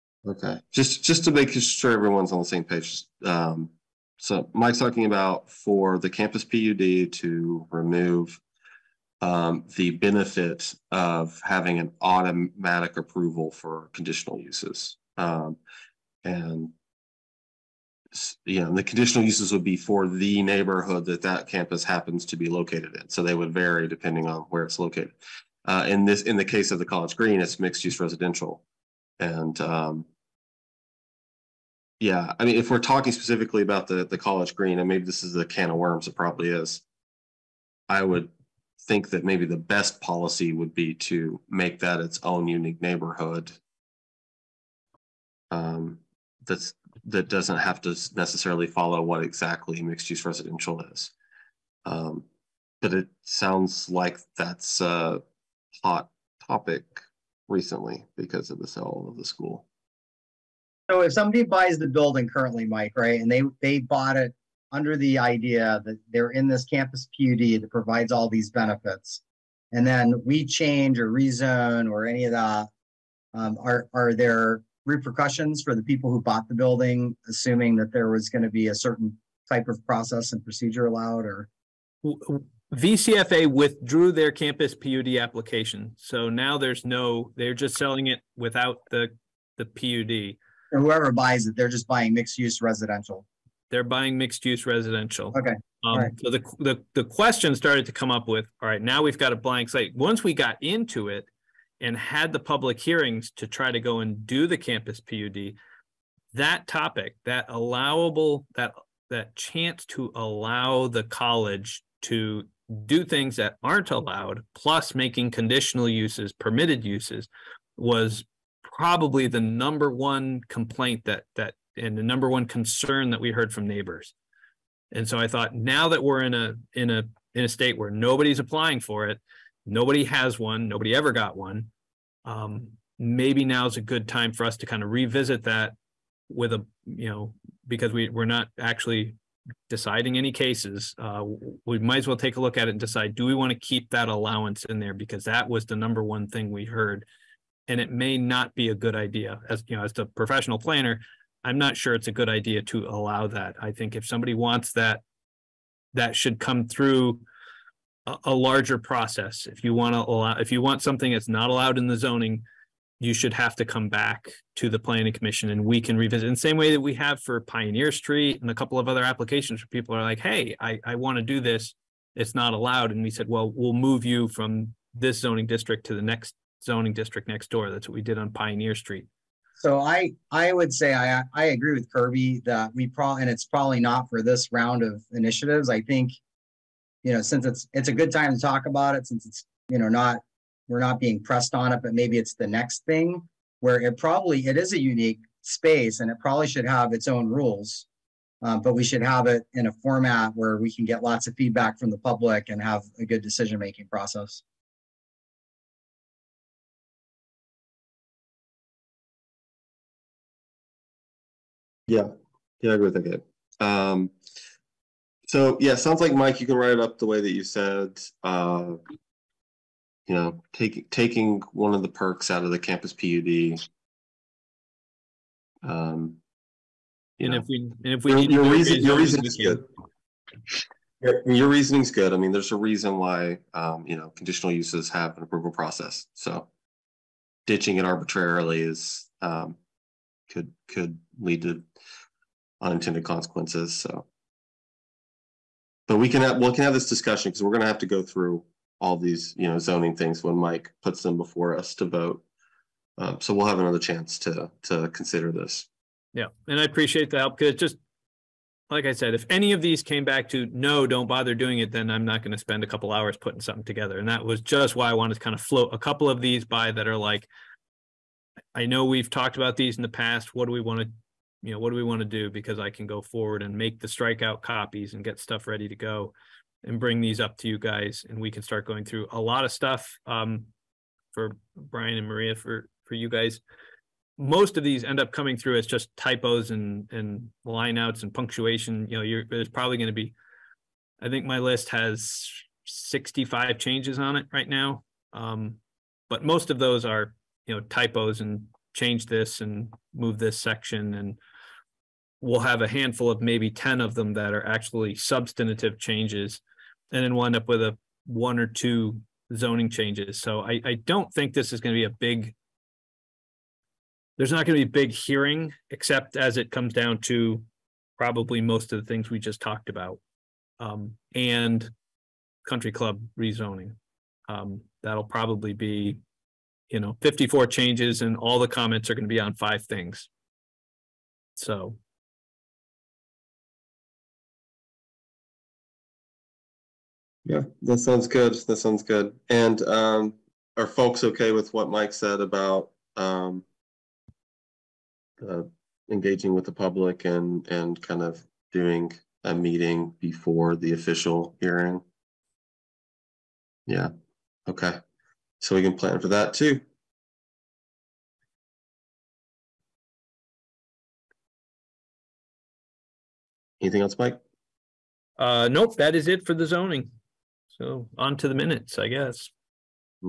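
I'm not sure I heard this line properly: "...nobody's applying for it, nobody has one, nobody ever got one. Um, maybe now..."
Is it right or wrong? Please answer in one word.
right.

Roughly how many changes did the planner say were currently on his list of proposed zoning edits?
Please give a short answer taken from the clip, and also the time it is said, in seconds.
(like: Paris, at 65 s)
65, at 292 s.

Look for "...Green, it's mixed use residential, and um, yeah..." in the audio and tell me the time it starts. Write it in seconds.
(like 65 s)
27 s.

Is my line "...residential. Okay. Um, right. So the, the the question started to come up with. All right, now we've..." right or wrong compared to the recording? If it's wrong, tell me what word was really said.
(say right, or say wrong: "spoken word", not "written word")
right.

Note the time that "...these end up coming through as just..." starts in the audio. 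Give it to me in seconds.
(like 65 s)
284 s.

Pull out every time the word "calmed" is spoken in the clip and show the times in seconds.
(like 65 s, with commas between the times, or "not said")
not said.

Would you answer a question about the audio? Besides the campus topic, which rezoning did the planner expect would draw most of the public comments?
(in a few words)
Country club rezoning.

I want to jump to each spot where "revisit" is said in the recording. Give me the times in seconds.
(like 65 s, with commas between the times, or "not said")
134 s, 165 s.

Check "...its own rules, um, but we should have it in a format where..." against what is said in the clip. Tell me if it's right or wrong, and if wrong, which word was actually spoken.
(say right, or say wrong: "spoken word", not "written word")
right.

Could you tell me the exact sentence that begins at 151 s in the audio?
I'm not sure it's a good idea to allow that.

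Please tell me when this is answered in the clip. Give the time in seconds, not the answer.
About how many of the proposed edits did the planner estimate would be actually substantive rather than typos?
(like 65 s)
303 s.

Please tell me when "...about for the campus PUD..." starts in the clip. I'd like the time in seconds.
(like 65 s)
5 s.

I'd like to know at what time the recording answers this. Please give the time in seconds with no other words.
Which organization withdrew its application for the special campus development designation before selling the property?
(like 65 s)
82 s.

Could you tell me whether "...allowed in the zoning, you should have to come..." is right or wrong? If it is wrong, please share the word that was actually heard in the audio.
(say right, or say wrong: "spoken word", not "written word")
right.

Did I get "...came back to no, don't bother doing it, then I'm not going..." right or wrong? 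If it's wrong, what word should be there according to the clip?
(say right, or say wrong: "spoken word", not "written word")
right.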